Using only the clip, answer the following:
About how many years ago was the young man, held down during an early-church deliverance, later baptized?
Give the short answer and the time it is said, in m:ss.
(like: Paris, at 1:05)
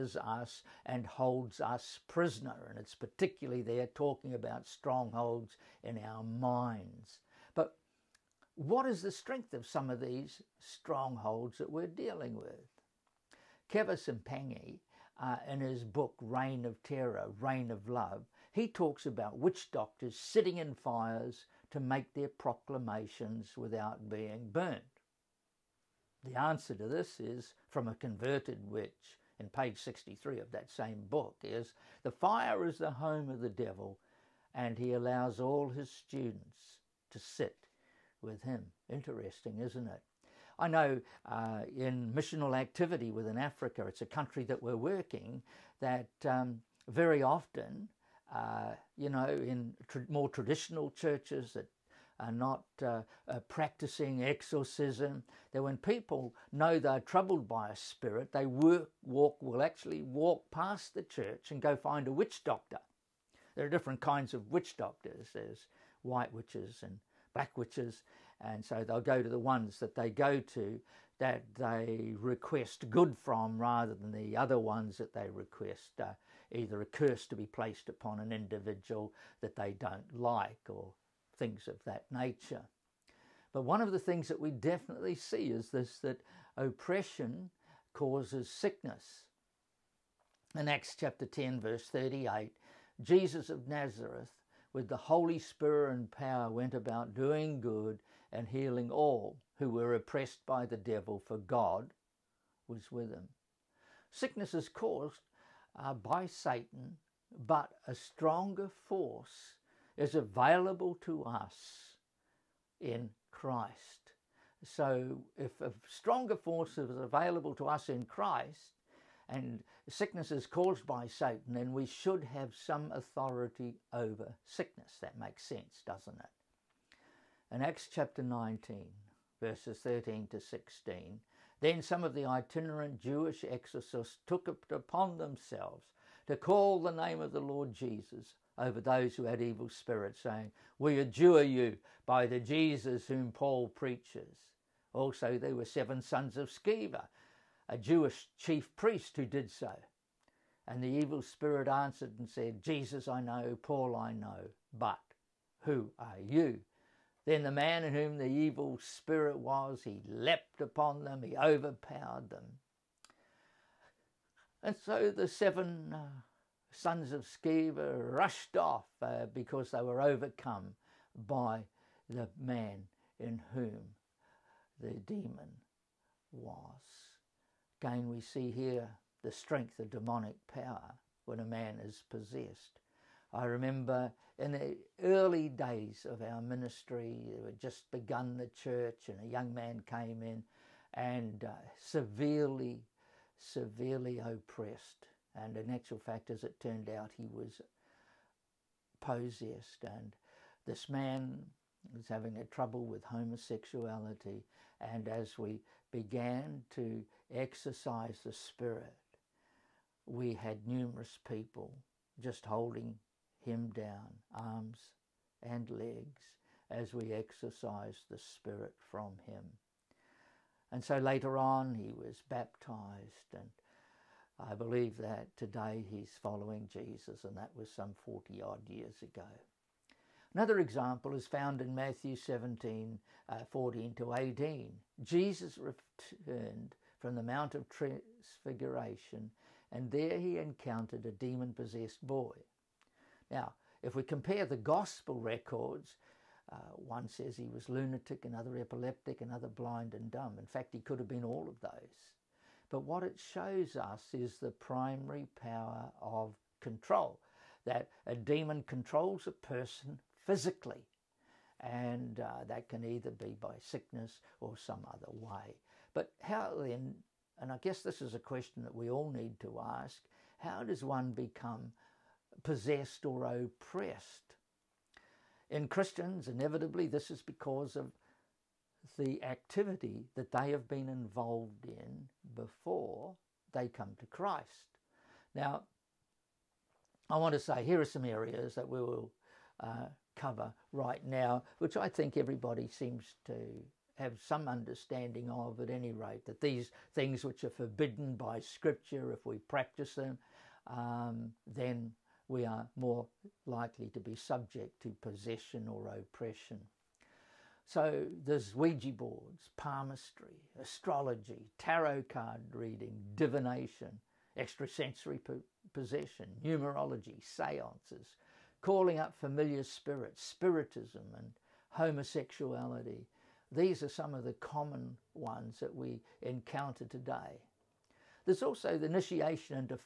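40, at 3:48.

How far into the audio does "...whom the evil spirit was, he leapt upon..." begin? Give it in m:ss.
2:37.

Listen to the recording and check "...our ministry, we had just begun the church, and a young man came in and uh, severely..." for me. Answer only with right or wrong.
right.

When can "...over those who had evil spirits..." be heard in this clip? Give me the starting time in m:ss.
2:18.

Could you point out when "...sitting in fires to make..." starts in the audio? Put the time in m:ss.
0:20.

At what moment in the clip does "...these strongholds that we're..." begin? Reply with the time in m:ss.
0:09.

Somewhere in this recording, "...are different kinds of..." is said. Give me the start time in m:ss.
1:03.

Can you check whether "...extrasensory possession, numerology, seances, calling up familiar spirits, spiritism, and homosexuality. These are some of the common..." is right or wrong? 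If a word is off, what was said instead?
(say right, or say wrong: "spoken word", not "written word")
right.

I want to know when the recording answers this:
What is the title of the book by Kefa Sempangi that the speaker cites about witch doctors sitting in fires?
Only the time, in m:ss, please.
0:16.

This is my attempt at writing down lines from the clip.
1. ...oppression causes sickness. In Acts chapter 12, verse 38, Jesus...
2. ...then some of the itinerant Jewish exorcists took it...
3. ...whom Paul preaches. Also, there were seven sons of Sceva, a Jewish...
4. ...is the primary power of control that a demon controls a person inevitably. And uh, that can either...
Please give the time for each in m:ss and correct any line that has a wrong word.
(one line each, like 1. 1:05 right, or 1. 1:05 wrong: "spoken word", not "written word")
1. 1:26 wrong: "10", not "12"
2. 2:11 right
3. 2:23 right
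4. 4:14 wrong: "physically", not "inevitably".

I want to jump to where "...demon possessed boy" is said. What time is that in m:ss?
4:01.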